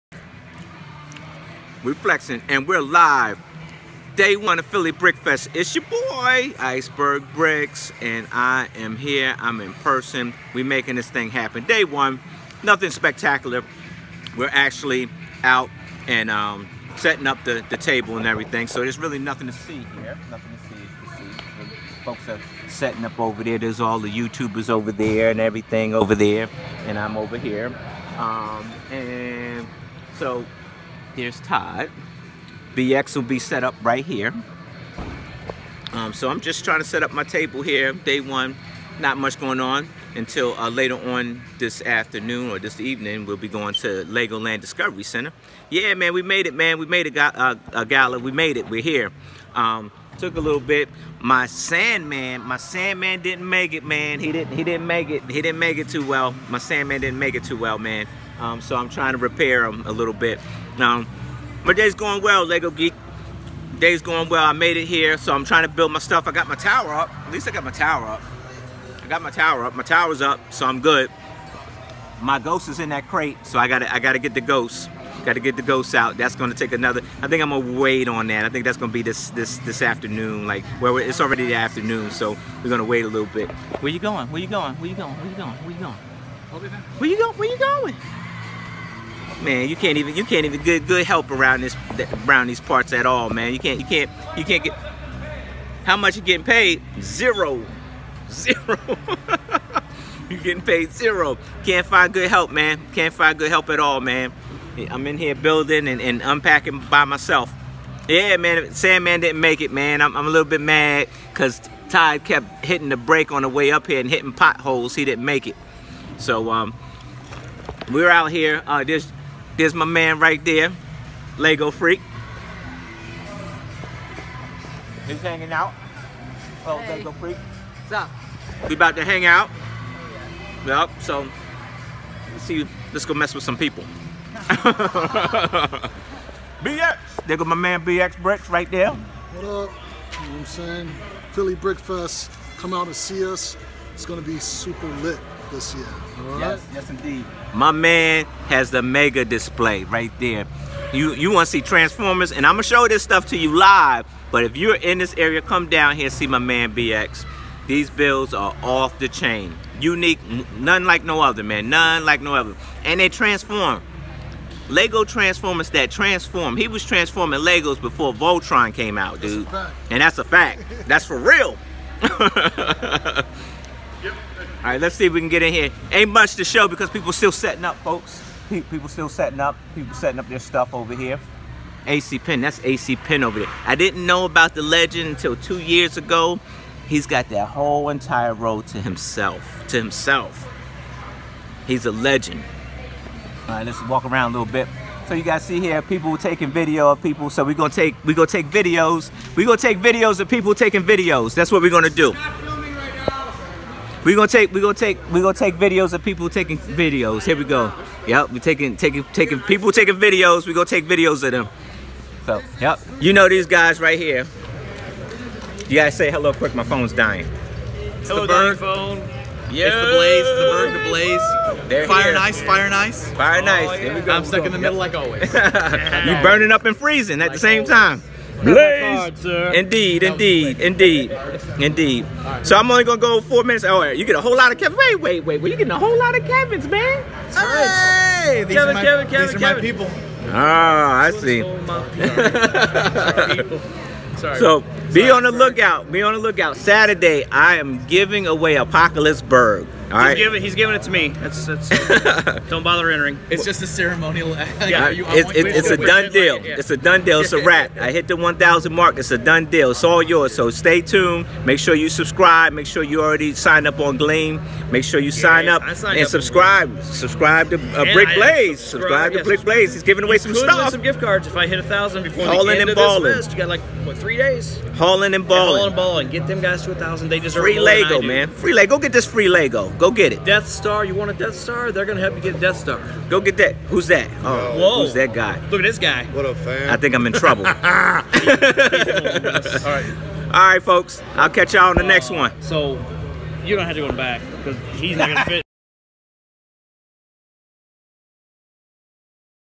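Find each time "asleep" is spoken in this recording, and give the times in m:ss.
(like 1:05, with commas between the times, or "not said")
not said.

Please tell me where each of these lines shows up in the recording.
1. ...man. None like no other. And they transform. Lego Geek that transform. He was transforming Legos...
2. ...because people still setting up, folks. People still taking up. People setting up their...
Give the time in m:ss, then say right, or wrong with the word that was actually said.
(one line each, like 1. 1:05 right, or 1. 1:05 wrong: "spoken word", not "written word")
1. 2:41 wrong: "Transformers", not "Geek"
2. 2:56 wrong: "setting", not "taking".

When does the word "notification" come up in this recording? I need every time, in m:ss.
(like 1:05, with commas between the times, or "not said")
not said.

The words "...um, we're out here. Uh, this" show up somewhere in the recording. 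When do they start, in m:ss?
1:56.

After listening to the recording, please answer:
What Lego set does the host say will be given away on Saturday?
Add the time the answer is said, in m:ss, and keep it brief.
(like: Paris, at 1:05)
Apocalypseburg, at 4:08.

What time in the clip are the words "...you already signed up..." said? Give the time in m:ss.
4:22.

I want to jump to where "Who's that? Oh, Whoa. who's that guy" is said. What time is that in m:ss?
4:43.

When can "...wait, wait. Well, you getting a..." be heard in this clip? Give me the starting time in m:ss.
3:54.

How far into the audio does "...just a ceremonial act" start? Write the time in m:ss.
4:13.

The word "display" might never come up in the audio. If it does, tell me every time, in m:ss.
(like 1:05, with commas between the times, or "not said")
2:29.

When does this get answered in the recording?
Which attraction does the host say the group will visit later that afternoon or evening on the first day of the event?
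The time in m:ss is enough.
0:44.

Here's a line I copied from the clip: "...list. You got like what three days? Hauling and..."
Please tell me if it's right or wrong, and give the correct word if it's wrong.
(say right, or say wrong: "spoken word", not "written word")
right.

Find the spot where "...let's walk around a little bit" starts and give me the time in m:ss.
3:13.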